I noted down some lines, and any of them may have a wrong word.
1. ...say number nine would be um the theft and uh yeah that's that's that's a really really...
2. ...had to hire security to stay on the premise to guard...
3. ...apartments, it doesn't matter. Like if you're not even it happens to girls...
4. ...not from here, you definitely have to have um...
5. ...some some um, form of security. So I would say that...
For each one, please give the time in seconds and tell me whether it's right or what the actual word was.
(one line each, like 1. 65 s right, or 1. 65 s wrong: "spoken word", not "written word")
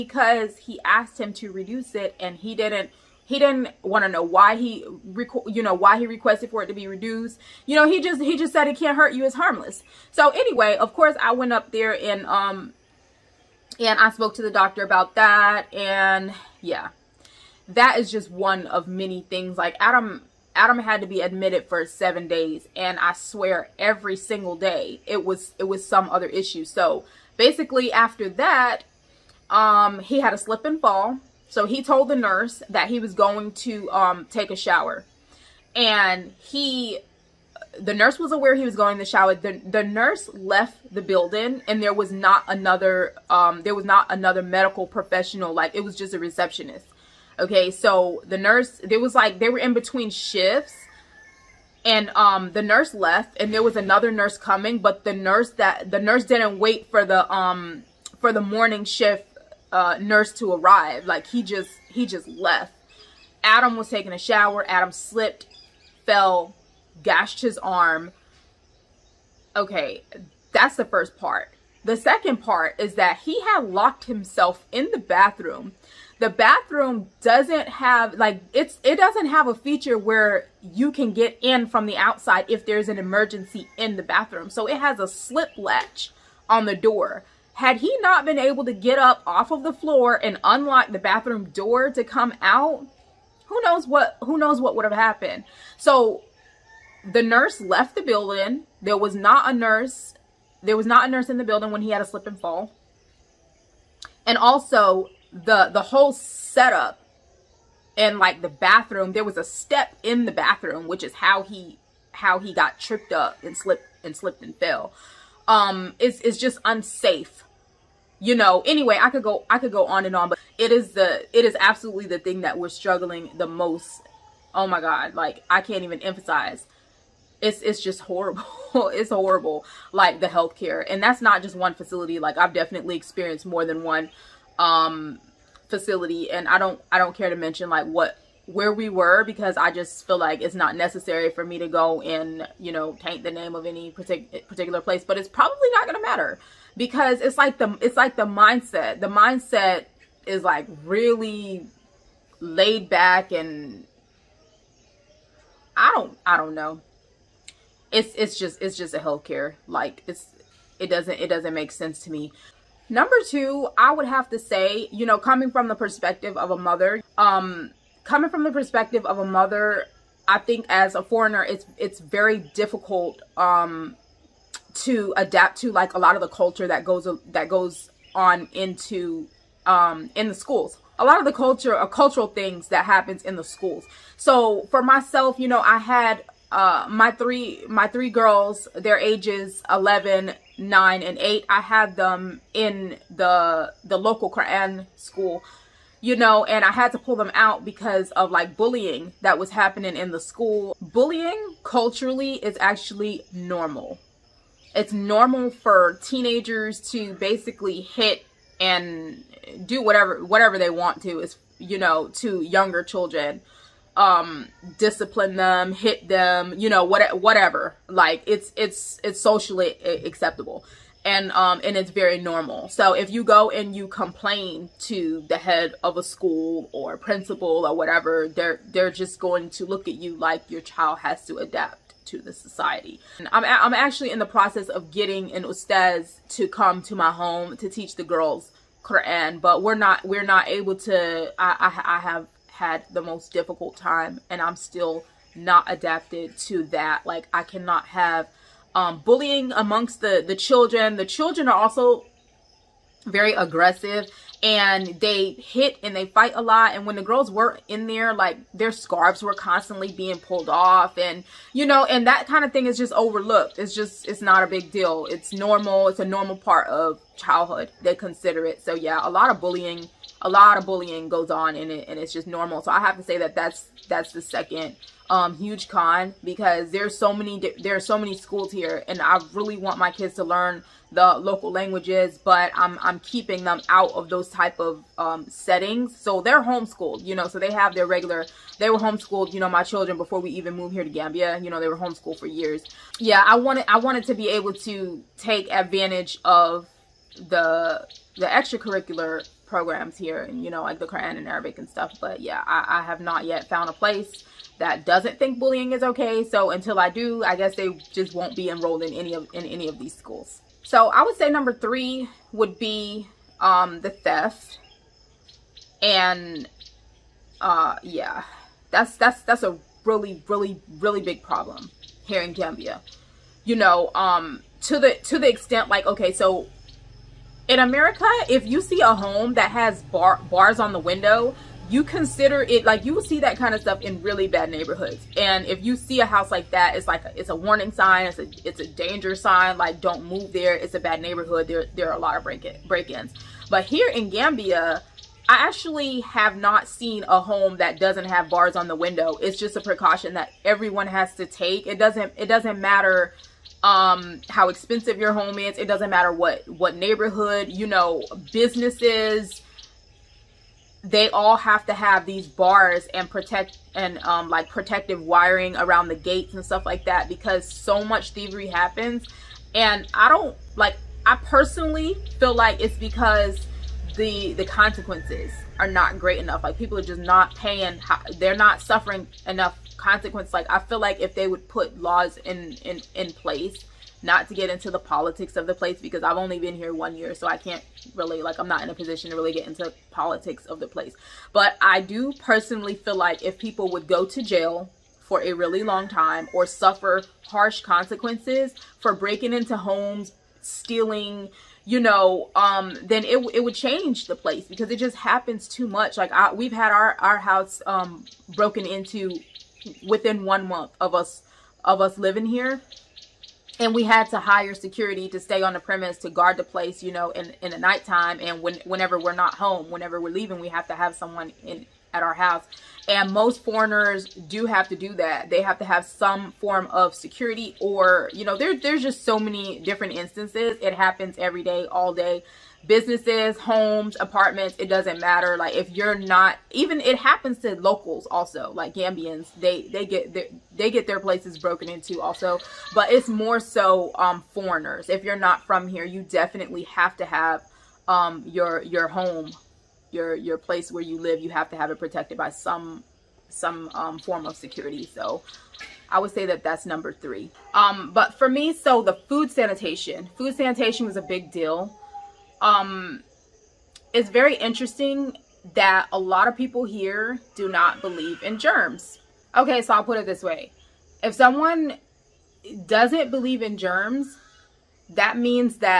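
1. 311 s wrong: "three", not "nine"
2. 413 s right
3. 434 s wrong: "locals", not "girls"
4. 445 s right
5. 452 s right.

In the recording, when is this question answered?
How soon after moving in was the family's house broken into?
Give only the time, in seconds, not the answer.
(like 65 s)
410 s.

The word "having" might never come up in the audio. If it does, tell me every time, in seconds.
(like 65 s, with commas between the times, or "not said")
not said.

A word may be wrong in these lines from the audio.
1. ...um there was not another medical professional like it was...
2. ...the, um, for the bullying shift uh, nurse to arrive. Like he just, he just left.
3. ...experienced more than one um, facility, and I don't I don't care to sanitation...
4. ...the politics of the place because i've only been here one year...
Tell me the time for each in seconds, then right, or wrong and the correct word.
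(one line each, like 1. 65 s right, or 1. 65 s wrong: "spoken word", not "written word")
1. 43 s right
2. 57 s wrong: "morning", not "bullying"
3. 132 s wrong: "mention", not "sanitation"
4. 384 s right.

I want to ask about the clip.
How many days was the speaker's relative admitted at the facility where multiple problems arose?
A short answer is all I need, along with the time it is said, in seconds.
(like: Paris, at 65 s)
7, at 21 s.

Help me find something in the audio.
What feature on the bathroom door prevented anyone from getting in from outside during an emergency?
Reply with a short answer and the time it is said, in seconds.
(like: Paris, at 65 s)
slip latch, at 85 s.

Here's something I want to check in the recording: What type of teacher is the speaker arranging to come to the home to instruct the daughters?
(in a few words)
ustaz.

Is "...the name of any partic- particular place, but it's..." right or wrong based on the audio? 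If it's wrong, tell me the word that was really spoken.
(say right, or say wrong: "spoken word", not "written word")
right.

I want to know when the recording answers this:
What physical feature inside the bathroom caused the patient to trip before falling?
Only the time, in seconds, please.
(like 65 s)
109 s.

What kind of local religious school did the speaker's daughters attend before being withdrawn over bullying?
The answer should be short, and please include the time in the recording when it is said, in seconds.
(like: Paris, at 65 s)
Quran school, at 194 s.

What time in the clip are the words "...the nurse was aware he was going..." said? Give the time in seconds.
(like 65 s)
37 s.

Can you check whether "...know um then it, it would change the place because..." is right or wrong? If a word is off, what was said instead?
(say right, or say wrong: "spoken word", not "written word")
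right.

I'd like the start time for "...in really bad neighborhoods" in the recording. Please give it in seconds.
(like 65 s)
333 s.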